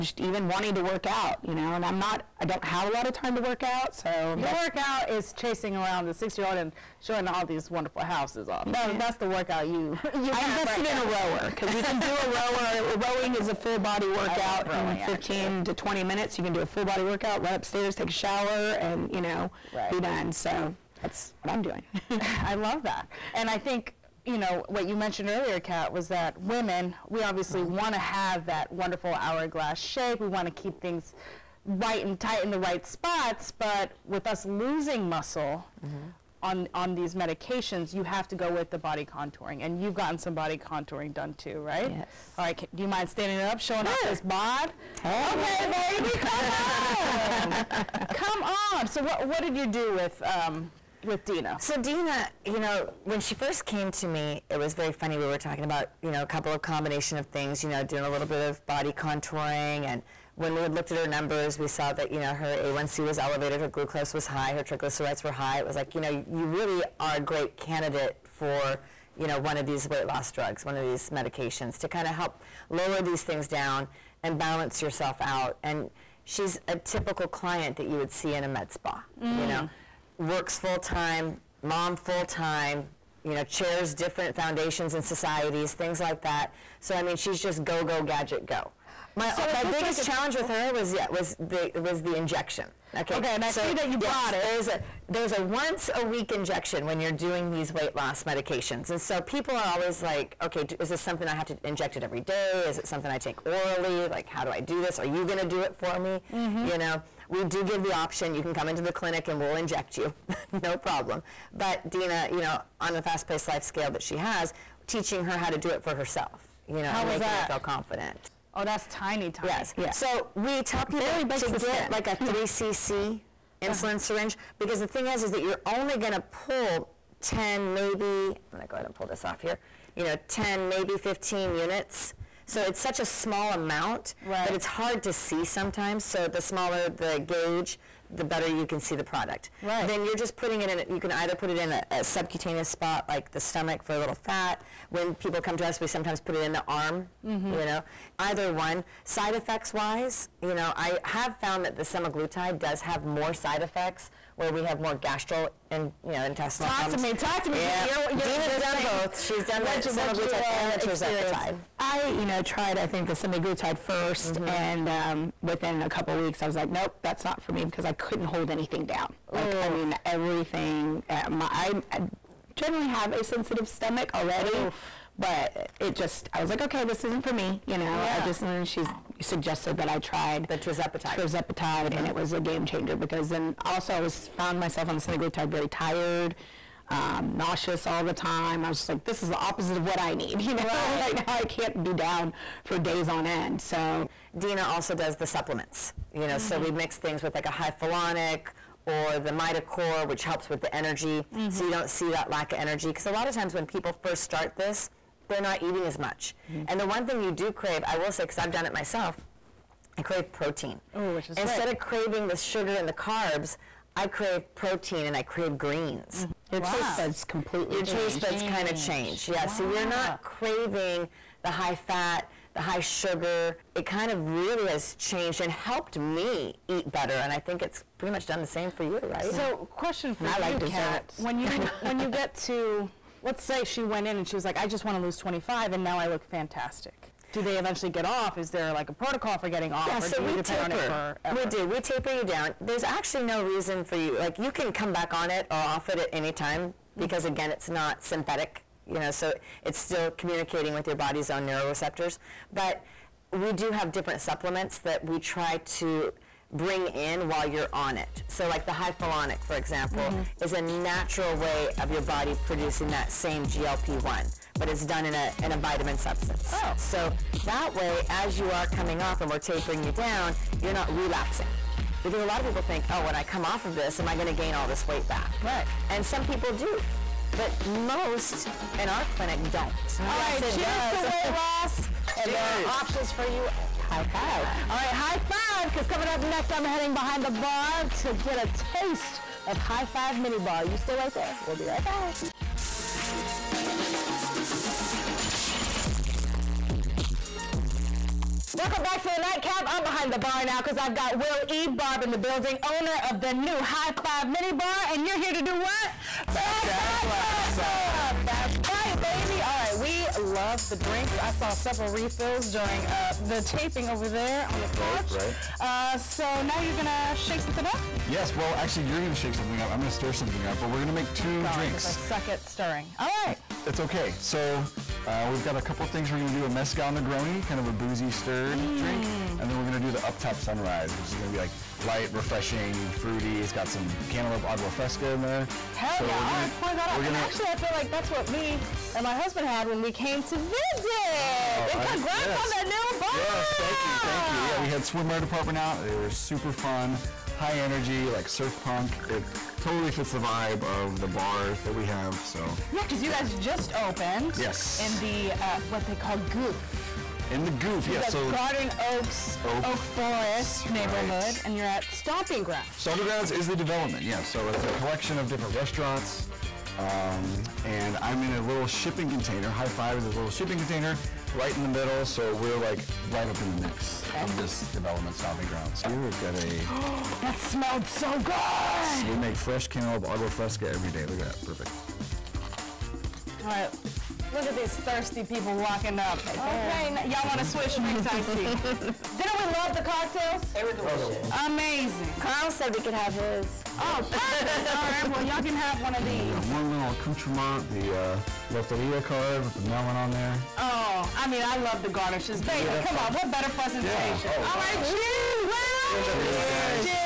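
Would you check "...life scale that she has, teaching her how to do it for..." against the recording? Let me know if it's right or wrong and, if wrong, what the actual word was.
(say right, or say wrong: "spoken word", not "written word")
right.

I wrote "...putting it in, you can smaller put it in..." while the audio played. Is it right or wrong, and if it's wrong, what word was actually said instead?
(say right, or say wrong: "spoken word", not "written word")
wrong: "either", not "smaller".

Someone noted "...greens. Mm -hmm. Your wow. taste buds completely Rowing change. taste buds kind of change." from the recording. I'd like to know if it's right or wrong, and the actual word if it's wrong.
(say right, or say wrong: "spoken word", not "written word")
wrong: "Your", not "Rowing".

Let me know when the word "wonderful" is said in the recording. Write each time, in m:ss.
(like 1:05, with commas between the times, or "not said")
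0:07, 0:28.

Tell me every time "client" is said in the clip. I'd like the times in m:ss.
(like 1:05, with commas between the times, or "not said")
1:17.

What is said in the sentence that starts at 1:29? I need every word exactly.
My so my biggest like challenge with her was yeah was the was the injection.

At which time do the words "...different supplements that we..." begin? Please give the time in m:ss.
4:13.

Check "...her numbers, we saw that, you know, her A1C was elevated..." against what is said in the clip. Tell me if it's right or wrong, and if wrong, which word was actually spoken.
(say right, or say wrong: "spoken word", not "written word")
right.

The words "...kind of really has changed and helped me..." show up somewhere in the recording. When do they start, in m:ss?
3:43.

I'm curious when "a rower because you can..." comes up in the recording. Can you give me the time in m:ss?
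0:11.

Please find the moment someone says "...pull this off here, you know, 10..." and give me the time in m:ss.
2:08.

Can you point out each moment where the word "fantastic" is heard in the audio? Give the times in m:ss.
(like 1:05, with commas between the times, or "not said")
3:56.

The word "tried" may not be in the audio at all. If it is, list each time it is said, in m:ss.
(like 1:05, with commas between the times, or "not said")
2:42, 2:59.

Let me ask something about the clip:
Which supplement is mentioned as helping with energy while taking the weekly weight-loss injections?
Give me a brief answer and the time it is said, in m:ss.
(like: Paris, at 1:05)
MitoCore, at 3:19.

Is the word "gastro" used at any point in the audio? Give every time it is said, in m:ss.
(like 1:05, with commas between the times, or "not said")
2:34.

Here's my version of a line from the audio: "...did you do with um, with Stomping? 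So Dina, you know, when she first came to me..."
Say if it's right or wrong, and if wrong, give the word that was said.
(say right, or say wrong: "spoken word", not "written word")
wrong: "Dina", not "Stomping".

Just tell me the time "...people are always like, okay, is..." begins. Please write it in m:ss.
1:39.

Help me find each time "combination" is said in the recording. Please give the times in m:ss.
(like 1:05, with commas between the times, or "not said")
0:56.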